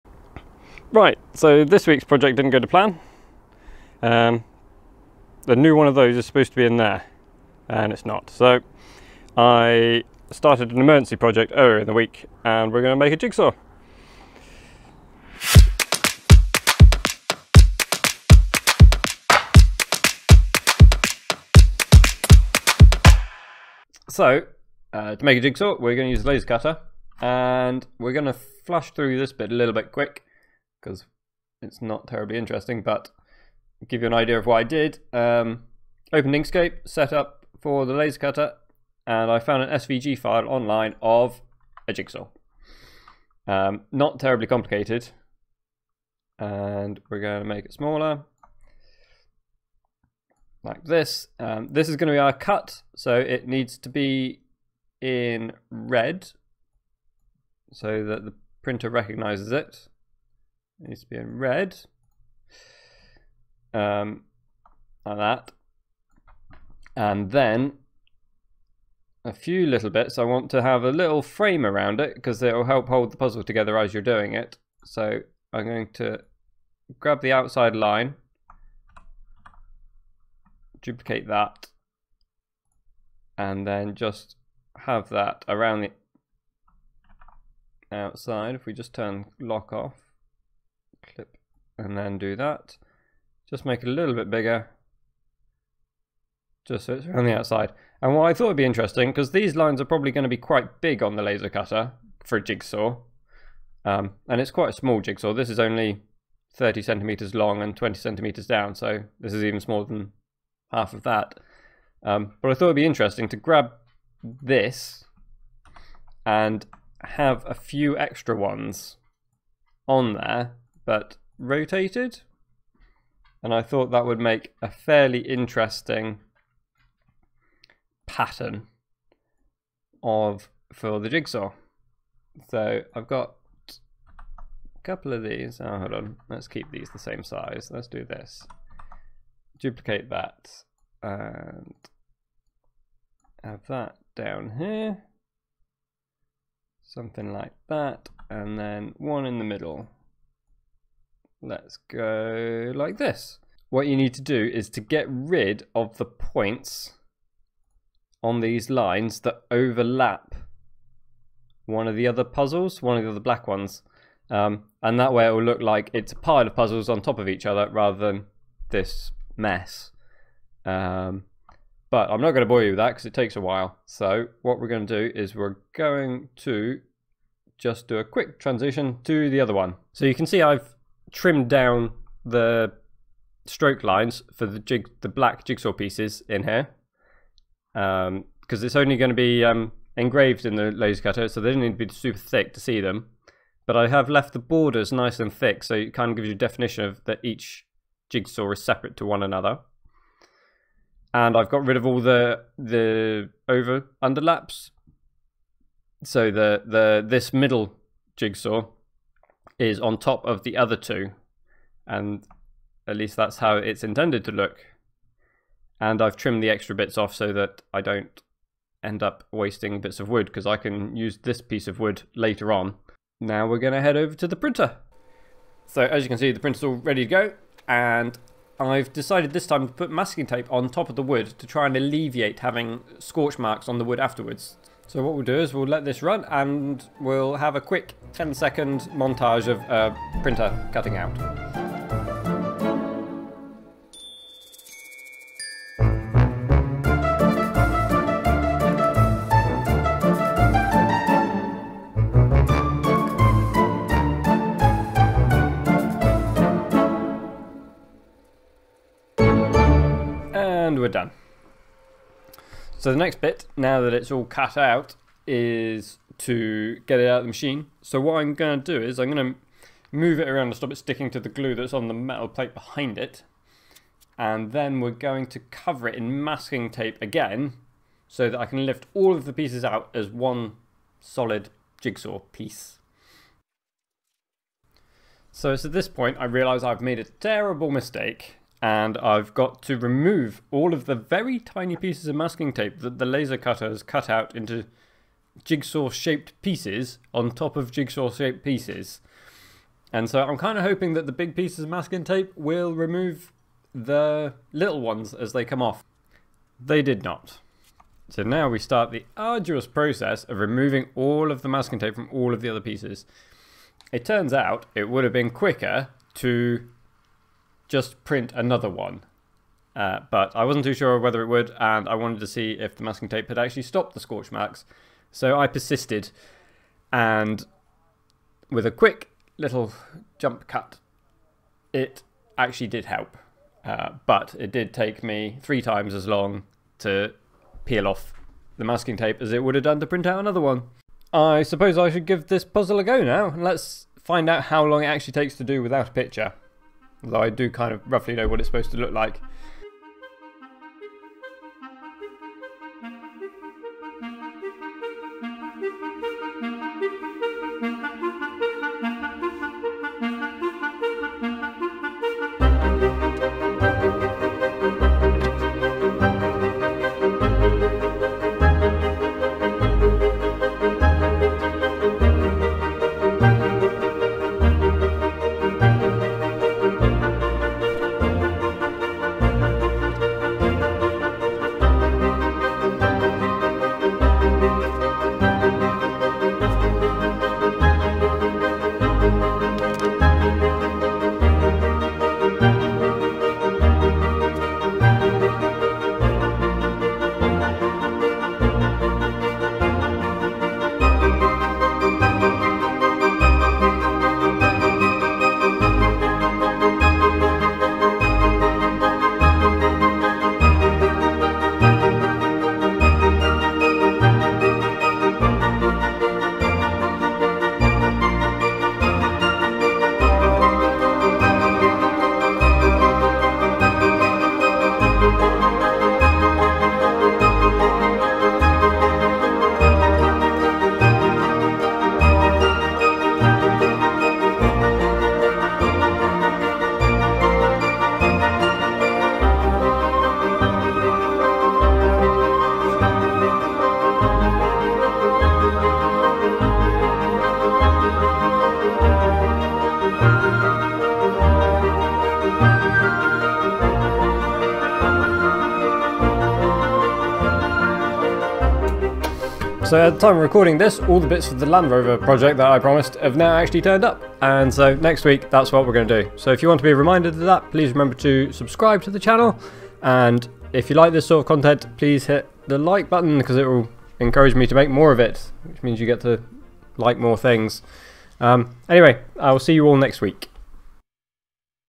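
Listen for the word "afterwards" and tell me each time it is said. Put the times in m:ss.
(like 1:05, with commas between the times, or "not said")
3:53.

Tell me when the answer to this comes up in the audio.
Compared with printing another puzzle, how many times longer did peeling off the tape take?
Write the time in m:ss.
5:35.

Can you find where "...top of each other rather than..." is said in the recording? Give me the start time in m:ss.
2:47.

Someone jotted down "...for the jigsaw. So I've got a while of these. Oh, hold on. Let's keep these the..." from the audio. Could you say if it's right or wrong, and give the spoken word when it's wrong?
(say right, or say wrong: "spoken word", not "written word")
wrong: "couple", not "while".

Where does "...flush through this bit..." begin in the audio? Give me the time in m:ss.
0:28.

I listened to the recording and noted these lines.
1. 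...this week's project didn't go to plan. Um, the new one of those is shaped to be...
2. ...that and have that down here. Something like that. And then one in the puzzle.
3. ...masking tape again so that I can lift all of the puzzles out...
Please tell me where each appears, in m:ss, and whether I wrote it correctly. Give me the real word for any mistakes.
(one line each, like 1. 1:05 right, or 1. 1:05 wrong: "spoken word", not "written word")
1. 0:01 wrong: "supposed", not "shaped"
2. 2:20 wrong: "middle", not "puzzle"
3. 4:36 wrong: "pieces", not "puzzles".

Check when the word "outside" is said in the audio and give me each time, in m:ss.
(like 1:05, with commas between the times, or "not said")
1:17, 1:27, 1:37.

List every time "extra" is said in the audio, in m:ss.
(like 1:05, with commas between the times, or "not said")
1:57, 3:36.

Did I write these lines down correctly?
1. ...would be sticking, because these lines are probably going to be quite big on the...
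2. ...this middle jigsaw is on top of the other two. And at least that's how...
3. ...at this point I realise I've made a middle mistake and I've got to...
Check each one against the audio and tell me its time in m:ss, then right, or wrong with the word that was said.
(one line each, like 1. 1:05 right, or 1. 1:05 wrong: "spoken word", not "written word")
1. 1:38 wrong: "interesting", not "sticking"
2. 3:27 right
3. 4:45 wrong: "terrible", not "middle".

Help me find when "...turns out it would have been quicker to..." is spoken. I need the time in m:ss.
5:14.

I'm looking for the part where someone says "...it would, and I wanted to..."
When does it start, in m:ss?
5:21.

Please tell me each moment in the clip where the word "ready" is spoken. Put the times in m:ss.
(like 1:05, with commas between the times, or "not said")
3:46.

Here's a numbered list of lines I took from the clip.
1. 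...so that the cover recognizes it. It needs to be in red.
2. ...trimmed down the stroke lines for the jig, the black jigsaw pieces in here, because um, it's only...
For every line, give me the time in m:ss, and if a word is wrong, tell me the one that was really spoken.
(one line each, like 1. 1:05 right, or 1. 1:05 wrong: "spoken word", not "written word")
1. 0:57 wrong: "printer", not "cover"
2. 3:01 right.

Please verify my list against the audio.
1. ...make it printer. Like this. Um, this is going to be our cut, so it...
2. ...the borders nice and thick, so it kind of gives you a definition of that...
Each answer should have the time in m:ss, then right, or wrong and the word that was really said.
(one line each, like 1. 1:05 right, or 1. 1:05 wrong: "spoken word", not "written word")
1. 0:47 wrong: "smaller", not "printer"
2. 3:14 right.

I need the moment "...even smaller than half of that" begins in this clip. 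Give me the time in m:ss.
1:49.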